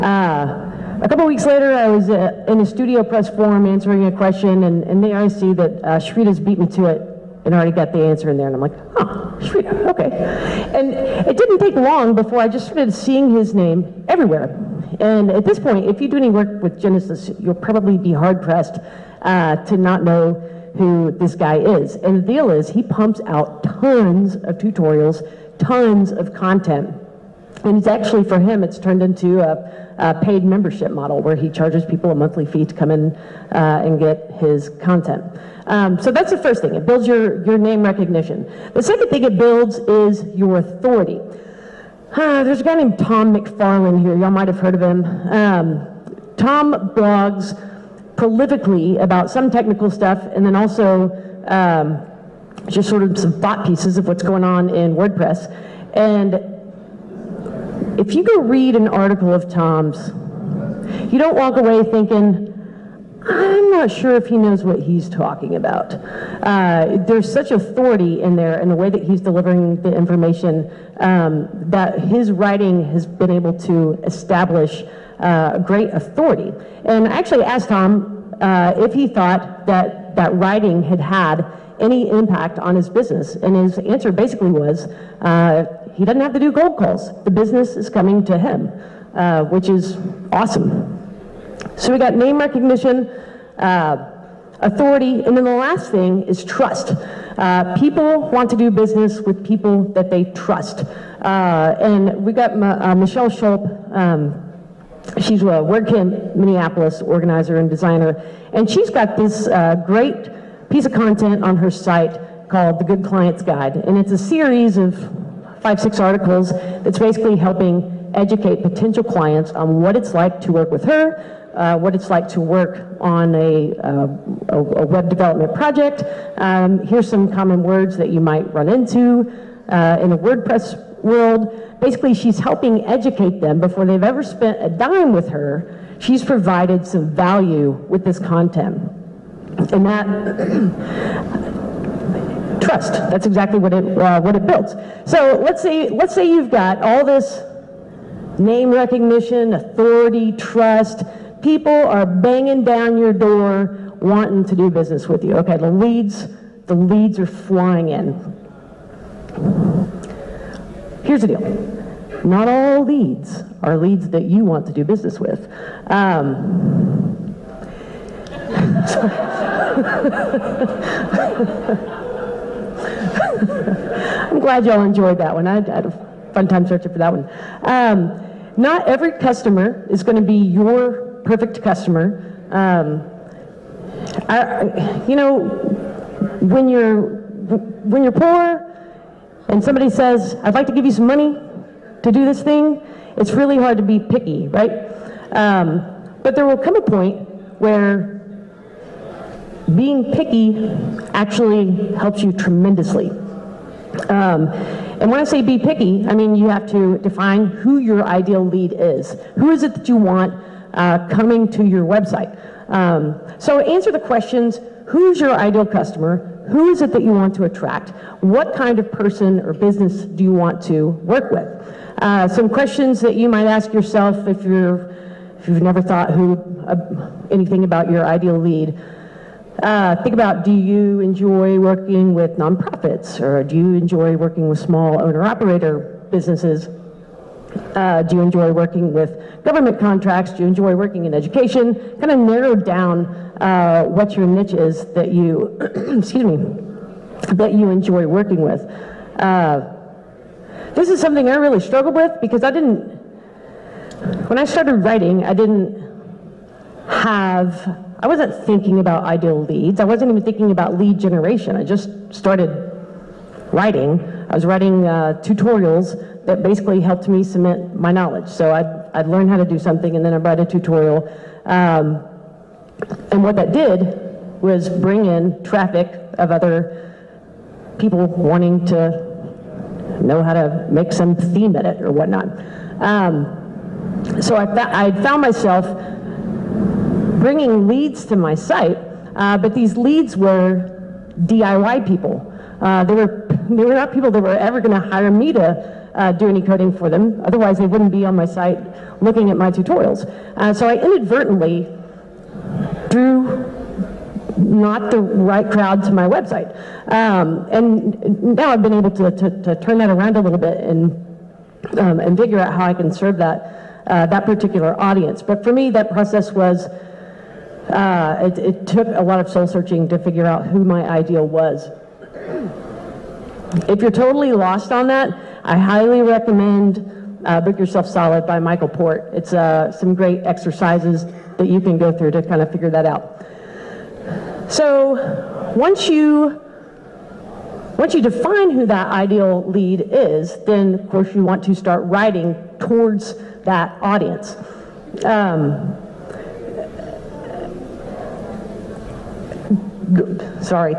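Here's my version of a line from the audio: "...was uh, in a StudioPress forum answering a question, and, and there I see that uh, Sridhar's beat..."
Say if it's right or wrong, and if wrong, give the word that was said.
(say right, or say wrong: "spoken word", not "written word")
right.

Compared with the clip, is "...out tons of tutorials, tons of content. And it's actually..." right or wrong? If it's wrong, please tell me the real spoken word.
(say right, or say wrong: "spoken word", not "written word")
right.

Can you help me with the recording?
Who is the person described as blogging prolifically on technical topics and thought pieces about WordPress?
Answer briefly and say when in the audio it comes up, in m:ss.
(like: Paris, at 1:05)
Tom McFarlin, at 0:42.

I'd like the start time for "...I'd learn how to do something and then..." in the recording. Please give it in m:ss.
4:28.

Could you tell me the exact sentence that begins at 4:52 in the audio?
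Uh, they were they were not people that were ever going to hire me to uh, do any coding for them.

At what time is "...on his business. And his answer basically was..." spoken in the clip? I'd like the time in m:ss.
1:22.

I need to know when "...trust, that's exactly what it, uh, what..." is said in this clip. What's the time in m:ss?
2:22.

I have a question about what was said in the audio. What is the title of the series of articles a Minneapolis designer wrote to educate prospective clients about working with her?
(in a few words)
The Good Clients Guide.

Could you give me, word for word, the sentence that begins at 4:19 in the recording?
I wasn't even thinking about lead generation.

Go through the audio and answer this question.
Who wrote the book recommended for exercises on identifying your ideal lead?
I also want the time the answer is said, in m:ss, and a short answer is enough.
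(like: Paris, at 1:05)
Michael Port, at 5:28.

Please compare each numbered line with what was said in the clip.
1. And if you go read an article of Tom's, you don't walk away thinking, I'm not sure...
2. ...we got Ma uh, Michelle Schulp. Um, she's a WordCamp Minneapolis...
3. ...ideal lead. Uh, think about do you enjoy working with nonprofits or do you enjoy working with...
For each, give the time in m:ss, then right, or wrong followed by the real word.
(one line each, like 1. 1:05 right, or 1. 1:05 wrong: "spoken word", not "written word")
1. 0:55 right
2. 1:42 right
3. 3:48 right.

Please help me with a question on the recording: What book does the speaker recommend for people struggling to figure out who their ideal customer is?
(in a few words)
Book Yourself Solid.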